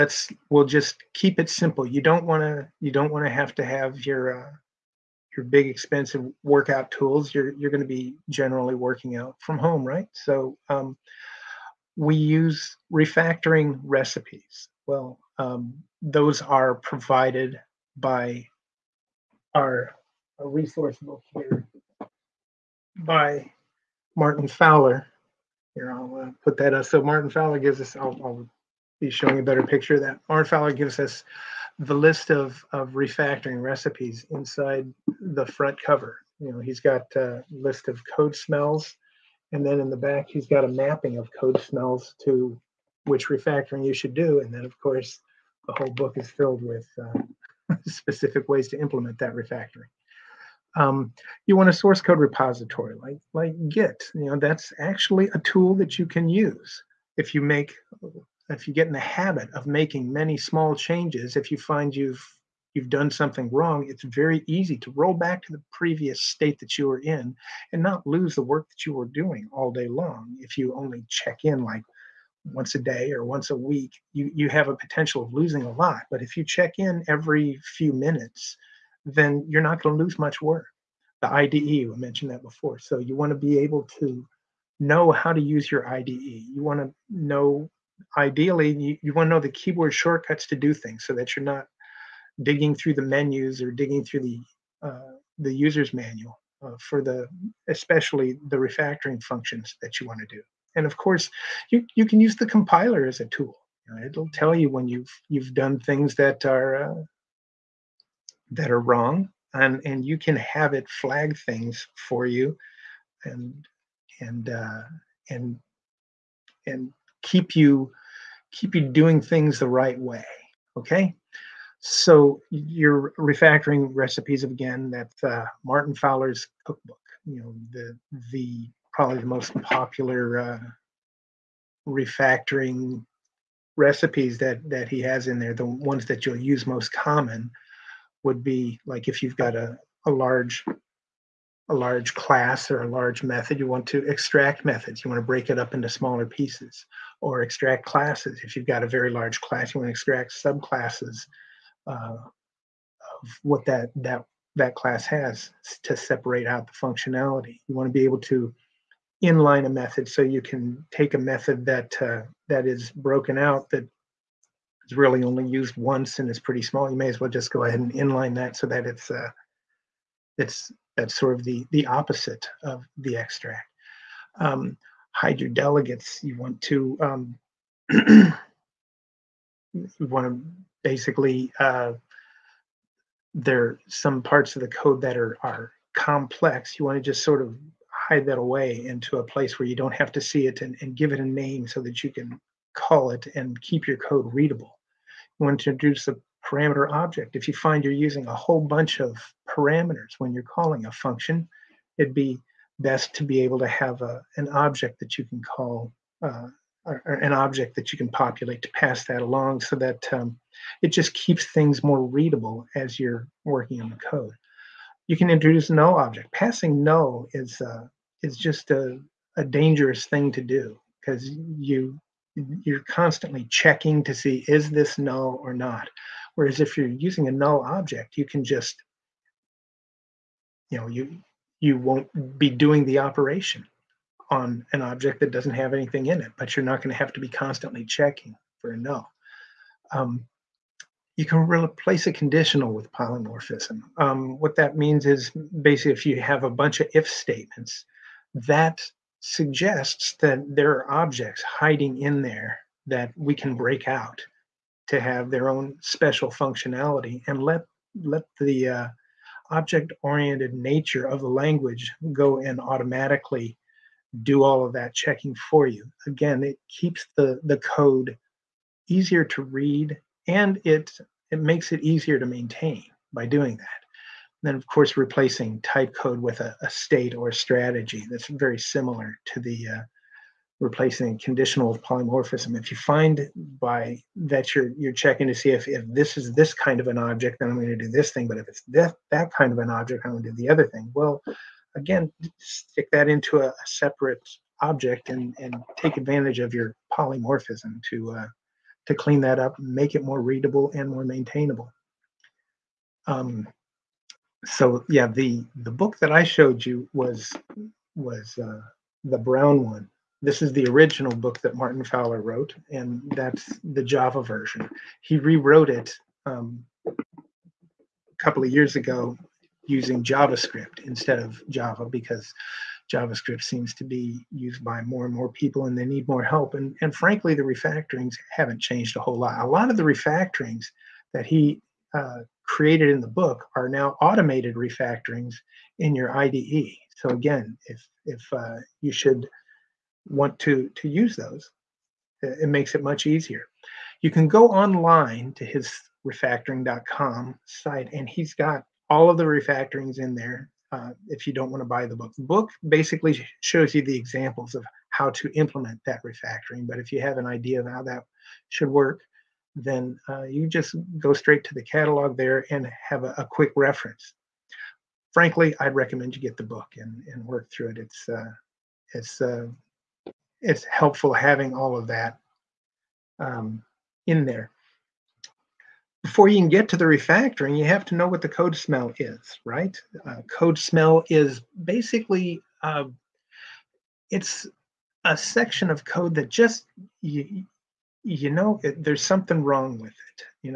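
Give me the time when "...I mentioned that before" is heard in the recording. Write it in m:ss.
1:21.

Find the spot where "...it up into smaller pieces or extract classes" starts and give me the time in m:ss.
2:25.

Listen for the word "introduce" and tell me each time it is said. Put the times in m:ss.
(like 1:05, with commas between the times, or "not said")
3:15, 3:35.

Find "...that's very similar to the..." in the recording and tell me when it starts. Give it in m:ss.
4:38.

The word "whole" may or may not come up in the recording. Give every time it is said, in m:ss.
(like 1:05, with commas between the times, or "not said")
0:45, 3:18, 5:28.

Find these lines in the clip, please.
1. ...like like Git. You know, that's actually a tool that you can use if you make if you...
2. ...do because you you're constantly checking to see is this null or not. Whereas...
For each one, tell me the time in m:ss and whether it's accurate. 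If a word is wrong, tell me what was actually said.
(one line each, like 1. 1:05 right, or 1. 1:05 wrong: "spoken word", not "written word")
1. 0:53 right
2. 3:40 right.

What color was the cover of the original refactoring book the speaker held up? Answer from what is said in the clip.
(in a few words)
brown.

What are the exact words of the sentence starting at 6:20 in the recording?
Uh, code smell is basically uh, it's a section of code that just you, you know it, there's something wrong with it.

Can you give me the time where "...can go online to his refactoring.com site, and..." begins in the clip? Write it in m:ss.
5:44.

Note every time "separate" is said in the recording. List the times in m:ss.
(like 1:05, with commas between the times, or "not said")
2:35, 4:53.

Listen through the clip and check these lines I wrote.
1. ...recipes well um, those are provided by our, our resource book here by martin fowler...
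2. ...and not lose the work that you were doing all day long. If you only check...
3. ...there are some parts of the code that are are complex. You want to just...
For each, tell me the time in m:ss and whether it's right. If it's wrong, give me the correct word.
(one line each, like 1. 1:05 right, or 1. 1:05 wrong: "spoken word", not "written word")
1. 0:13 right
2. 1:07 right
3. 3:03 right.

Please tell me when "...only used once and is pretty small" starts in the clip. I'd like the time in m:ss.
2:45.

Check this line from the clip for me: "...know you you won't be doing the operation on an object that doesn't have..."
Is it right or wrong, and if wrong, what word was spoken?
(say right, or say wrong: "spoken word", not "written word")
right.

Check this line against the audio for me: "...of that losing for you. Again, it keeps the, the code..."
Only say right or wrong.
wrong.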